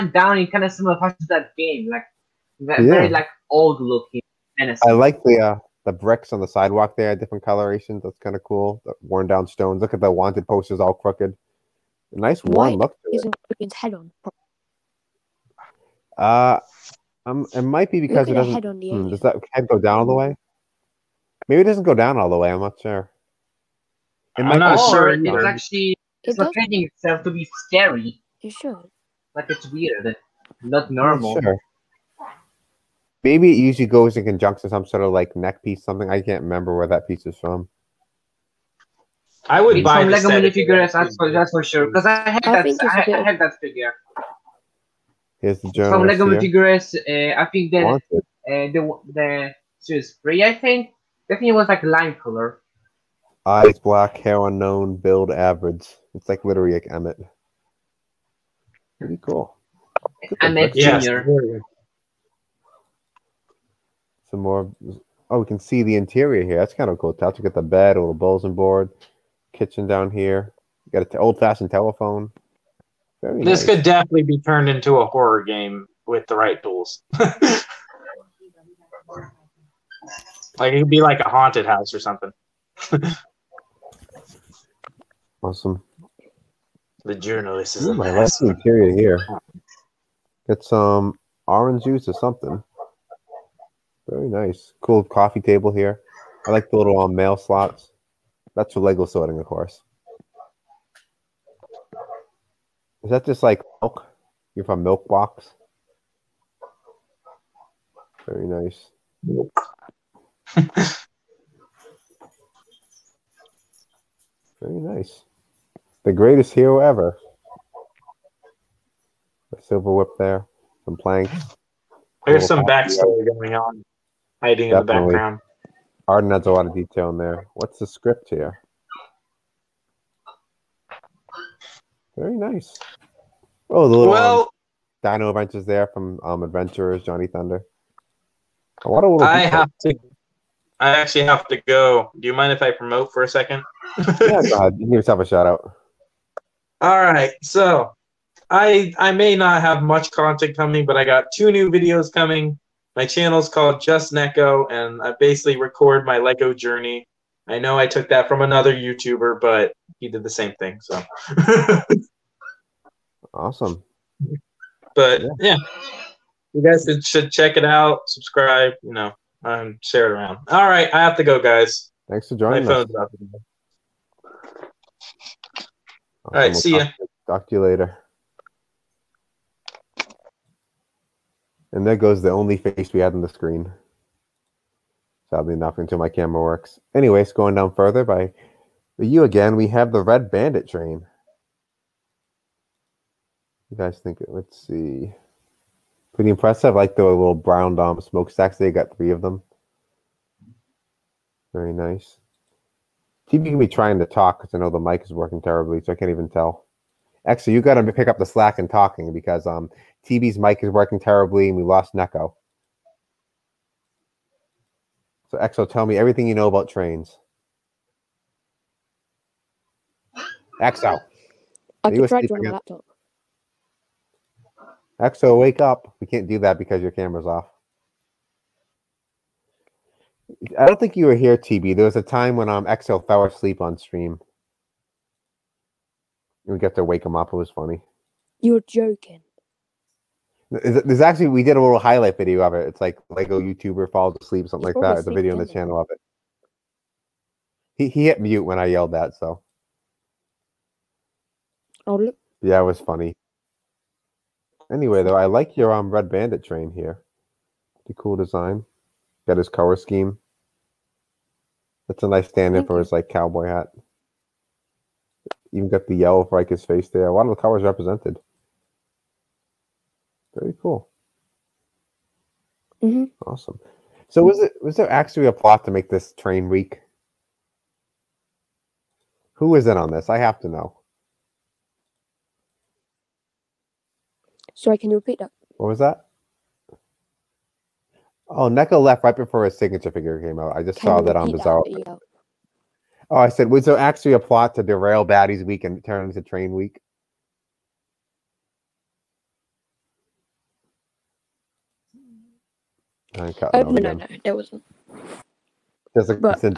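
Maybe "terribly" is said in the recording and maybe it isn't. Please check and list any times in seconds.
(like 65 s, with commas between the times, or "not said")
205 s, 210 s.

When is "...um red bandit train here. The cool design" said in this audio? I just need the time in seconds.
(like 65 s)
255 s.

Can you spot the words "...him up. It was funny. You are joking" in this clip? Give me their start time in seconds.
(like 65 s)
237 s.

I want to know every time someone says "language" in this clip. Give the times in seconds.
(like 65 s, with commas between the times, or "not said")
not said.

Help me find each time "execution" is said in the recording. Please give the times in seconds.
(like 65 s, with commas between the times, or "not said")
not said.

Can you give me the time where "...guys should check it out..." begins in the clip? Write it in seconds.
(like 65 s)
166 s.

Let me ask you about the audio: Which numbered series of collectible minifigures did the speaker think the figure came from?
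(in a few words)
series 3.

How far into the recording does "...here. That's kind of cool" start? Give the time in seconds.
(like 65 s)
66 s.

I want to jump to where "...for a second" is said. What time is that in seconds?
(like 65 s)
143 s.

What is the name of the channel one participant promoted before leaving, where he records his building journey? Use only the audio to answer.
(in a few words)
Just Neko.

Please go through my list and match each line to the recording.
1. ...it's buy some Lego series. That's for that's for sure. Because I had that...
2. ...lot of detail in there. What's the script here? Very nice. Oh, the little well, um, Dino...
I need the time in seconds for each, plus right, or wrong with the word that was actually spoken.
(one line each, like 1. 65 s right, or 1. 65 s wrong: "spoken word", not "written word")
1. 39 s wrong: "minifigures", not "series"
2. 126 s right.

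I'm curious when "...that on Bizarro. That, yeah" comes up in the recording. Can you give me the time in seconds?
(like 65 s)
291 s.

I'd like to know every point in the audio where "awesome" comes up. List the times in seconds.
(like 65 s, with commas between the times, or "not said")
85 s, 163 s, 176 s, 273 s.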